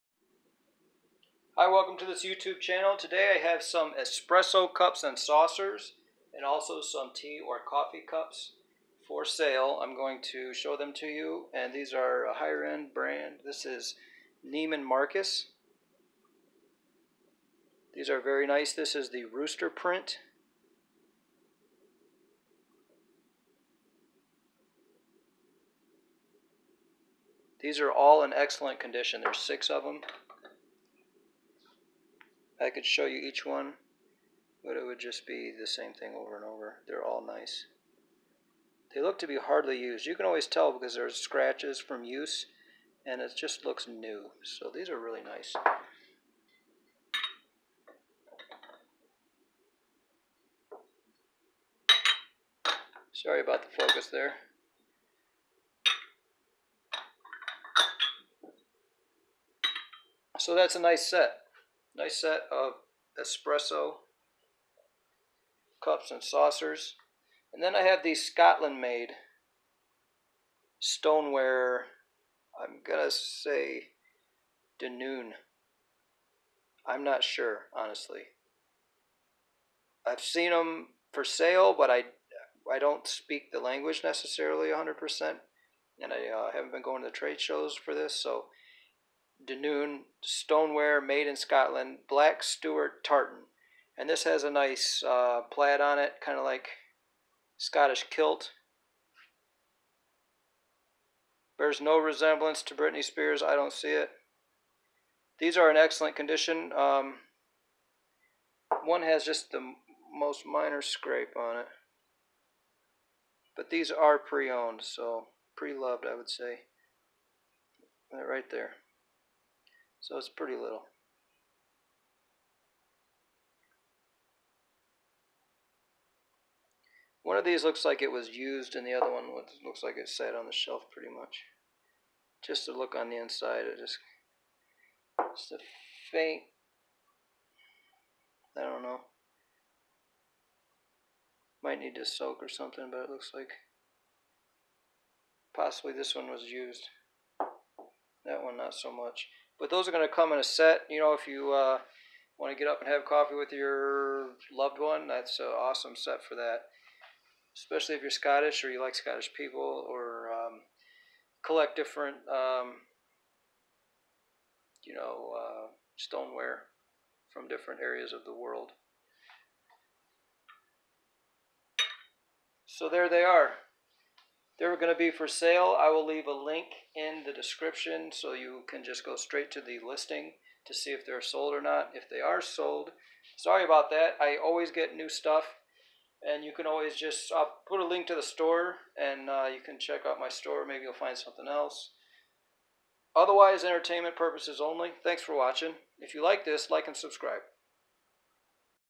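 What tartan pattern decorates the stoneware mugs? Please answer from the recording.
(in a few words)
Black Stuart tartan.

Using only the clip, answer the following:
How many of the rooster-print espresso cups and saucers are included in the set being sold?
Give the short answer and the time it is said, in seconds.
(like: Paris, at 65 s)
6, at 29 s.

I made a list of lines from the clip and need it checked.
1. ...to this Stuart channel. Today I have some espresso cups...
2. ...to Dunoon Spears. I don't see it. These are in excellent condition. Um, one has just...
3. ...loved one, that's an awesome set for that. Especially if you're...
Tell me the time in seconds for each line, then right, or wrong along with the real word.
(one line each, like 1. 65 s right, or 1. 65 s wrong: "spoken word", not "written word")
1. 1 s wrong: "YouTube", not "Stuart"
2. 102 s wrong: "Britney", not "Dunoon"
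3. 154 s right.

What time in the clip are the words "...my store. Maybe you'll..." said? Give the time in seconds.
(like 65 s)
190 s.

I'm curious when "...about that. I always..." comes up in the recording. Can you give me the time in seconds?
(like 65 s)
183 s.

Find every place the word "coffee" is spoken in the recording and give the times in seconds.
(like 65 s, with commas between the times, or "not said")
7 s, 153 s.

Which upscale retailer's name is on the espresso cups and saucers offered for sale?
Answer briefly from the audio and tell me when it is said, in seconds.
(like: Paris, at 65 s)
Neiman Marcus, at 14 s.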